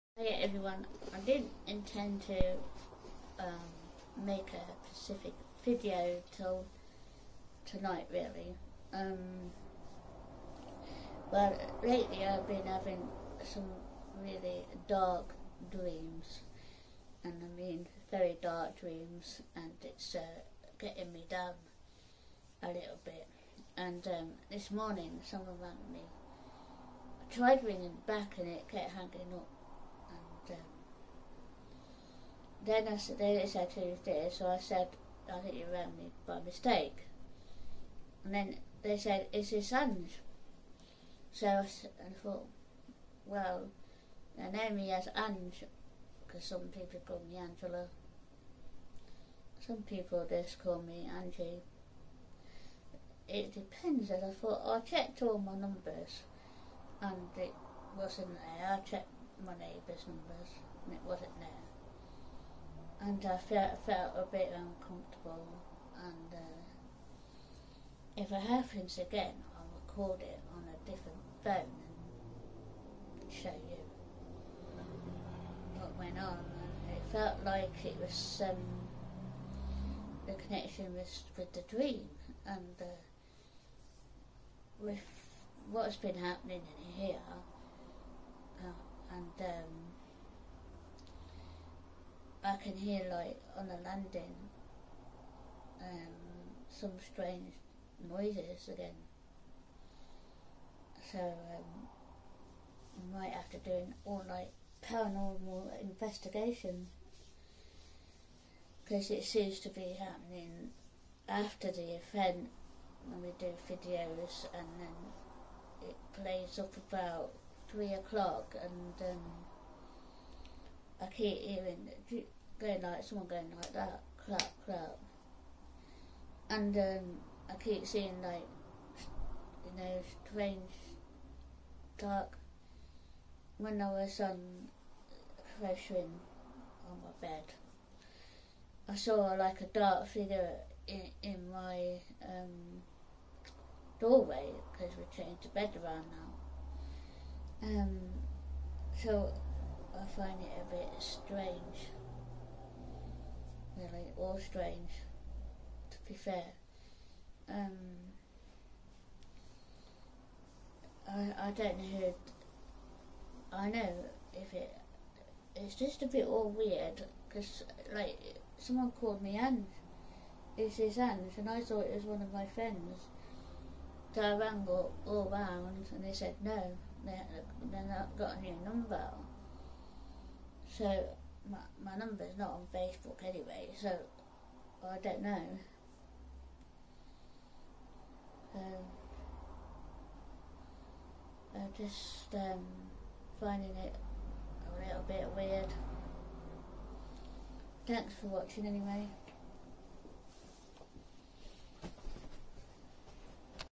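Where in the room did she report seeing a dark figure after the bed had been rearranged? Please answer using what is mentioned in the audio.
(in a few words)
doorway.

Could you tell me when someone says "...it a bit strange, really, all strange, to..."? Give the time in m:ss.
2:30.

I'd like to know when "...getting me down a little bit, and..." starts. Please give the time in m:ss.
0:20.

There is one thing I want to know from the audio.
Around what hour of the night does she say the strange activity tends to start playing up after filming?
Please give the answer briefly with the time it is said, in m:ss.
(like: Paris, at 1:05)
3 o'clock, at 1:57.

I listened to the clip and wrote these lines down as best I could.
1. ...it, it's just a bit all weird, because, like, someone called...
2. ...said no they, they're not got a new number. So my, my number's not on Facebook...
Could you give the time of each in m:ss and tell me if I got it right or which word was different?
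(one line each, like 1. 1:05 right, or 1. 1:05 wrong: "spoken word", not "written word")
1. 2:44 right
2. 2:56 right.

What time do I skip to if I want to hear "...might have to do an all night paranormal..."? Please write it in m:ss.
1:43.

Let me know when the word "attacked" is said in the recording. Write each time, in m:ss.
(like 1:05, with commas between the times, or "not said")
not said.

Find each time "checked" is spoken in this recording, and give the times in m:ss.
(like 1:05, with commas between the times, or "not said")
0:54, 0:58.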